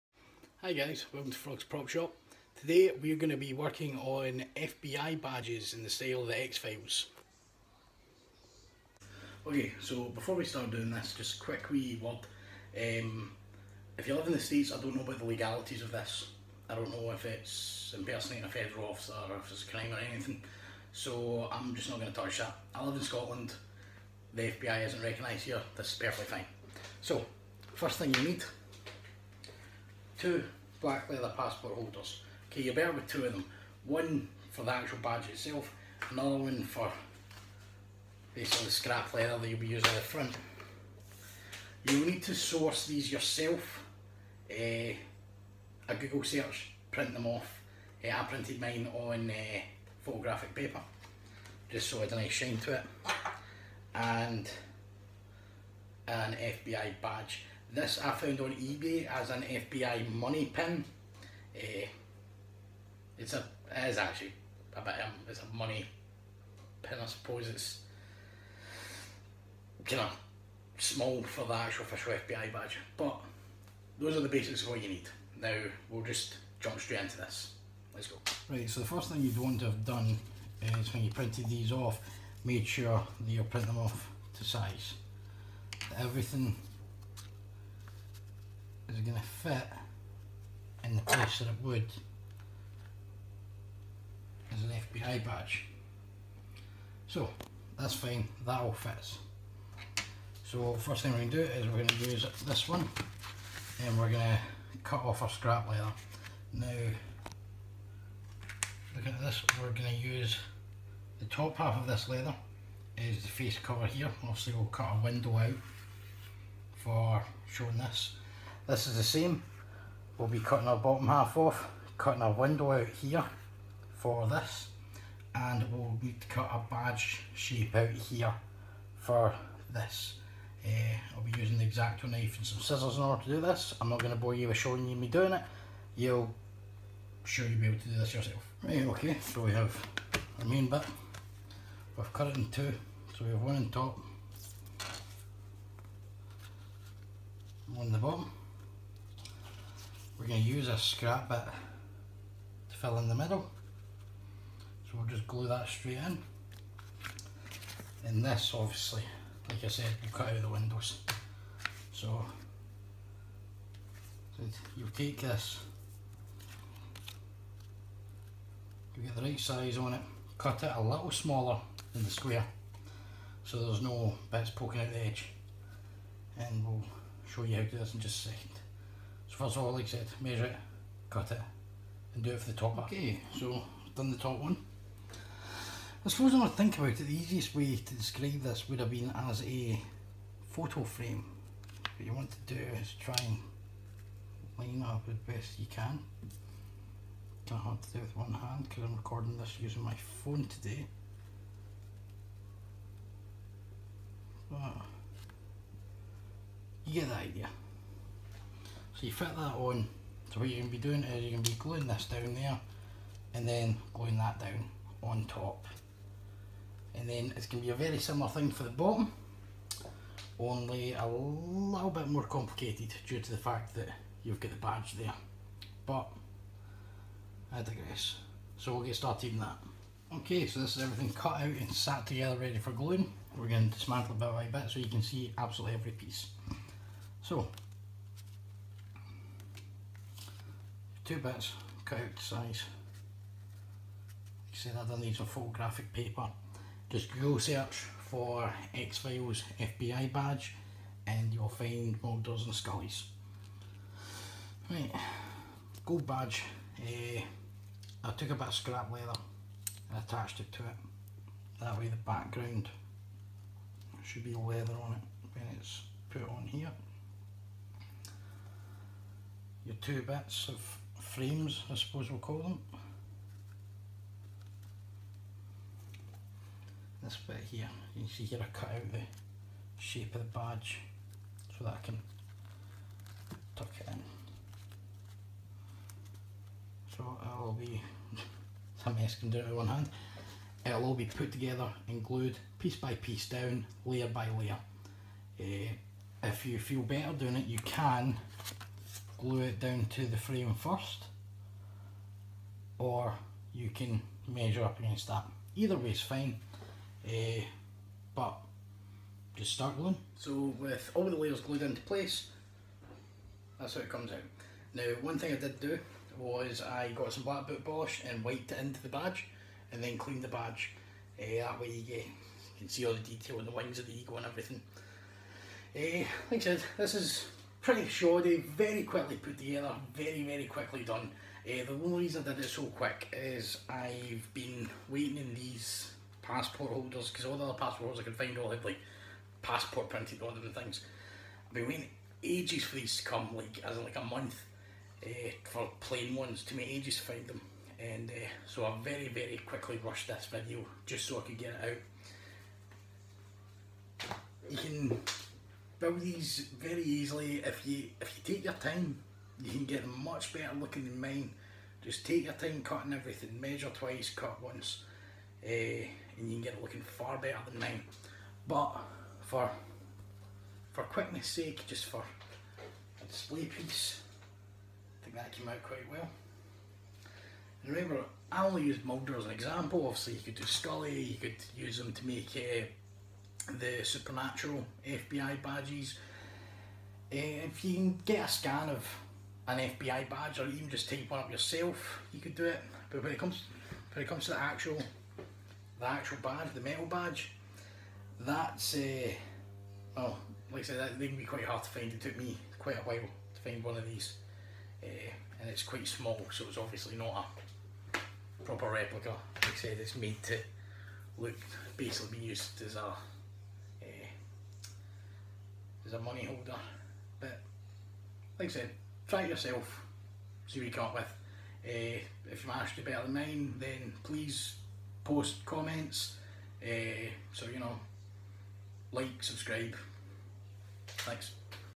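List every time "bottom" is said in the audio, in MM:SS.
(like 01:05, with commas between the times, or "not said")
02:00, 02:27, 03:38.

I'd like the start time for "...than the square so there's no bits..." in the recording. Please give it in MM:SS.
02:51.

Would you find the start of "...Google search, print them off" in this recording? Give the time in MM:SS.
00:45.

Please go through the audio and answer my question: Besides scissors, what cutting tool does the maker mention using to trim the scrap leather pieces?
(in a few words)
X-Acto knife.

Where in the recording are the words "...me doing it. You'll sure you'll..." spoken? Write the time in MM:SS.
02:14.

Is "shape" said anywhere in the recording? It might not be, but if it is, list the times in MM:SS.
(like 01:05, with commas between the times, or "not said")
02:07, 04:39.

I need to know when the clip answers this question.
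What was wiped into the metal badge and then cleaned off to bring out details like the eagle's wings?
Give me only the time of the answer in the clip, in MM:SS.
05:17.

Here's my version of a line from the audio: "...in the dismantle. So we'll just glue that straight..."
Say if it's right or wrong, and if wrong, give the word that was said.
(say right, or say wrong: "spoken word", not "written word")
wrong: "middle", not "dismantle".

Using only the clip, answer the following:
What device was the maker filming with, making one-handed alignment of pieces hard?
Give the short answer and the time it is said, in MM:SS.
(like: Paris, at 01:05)
Phone, at 03:19.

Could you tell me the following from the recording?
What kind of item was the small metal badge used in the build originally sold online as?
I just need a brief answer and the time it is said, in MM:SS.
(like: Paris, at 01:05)
FBI money pin, at 00:59.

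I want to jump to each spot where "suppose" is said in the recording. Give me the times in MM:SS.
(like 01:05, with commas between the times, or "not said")
01:07, 03:06, 04:31.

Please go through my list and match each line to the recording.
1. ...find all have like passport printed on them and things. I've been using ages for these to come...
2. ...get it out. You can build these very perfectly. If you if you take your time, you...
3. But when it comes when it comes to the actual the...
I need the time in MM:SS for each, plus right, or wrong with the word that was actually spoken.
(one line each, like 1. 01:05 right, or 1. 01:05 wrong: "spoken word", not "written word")
1. 05:38 wrong: "waiting", not "using"
2. 05:51 wrong: "easily", not "perfectly"
3. 06:32 right.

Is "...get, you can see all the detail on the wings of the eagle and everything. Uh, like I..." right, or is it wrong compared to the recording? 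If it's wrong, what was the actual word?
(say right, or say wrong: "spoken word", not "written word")
right.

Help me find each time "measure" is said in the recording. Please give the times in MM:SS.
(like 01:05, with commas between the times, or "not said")
03:00, 05:04, 06:03.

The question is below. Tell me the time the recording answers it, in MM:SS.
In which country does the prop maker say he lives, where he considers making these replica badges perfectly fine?
00:23.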